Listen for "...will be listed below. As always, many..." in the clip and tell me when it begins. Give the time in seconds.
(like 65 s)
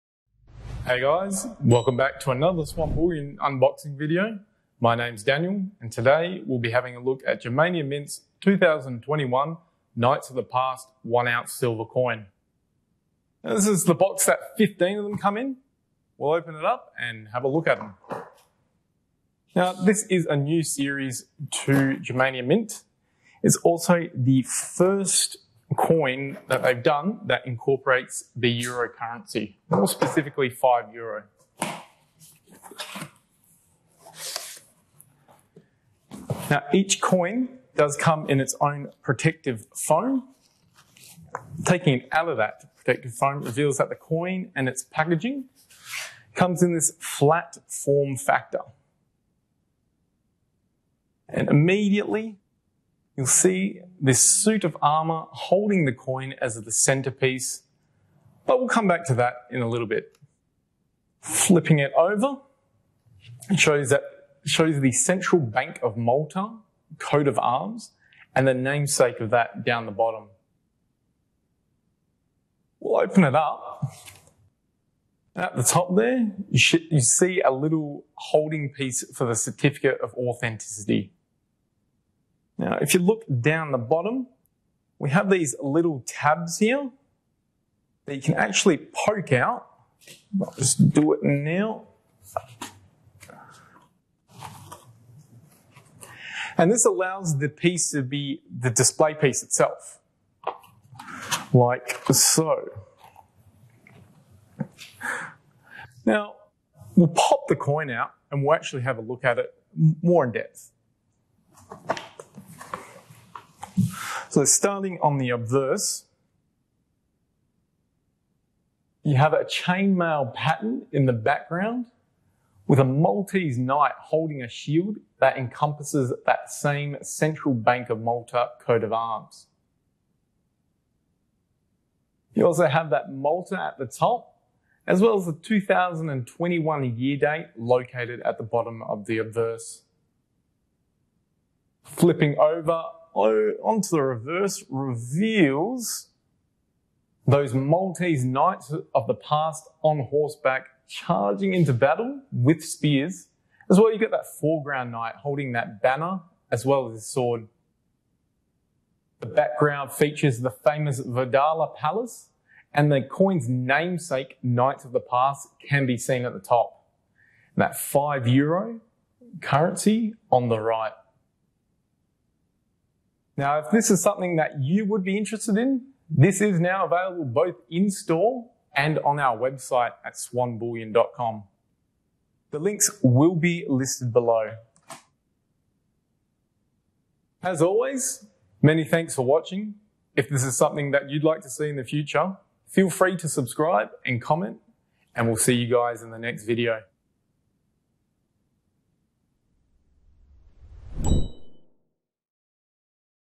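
183 s.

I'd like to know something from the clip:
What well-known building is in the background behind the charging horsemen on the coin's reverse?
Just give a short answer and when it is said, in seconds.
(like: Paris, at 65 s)
Verdala Palace, at 161 s.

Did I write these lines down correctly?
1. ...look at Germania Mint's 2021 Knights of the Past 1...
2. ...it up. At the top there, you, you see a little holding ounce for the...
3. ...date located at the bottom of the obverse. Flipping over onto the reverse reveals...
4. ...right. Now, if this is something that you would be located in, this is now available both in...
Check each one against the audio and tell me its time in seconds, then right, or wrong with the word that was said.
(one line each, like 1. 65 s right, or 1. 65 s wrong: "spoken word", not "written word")
1. 6 s right
2. 73 s wrong: "piece", not "ounce"
3. 137 s right
4. 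170 s wrong: "interested", not "located".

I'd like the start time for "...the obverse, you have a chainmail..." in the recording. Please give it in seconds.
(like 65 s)
115 s.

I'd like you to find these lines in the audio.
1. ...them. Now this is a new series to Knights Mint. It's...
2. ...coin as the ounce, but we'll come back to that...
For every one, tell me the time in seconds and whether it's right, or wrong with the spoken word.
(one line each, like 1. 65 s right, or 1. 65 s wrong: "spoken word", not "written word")
1. 17 s wrong: "Germania", not "Knights"
2. 55 s wrong: "centerpiece", not "ounce".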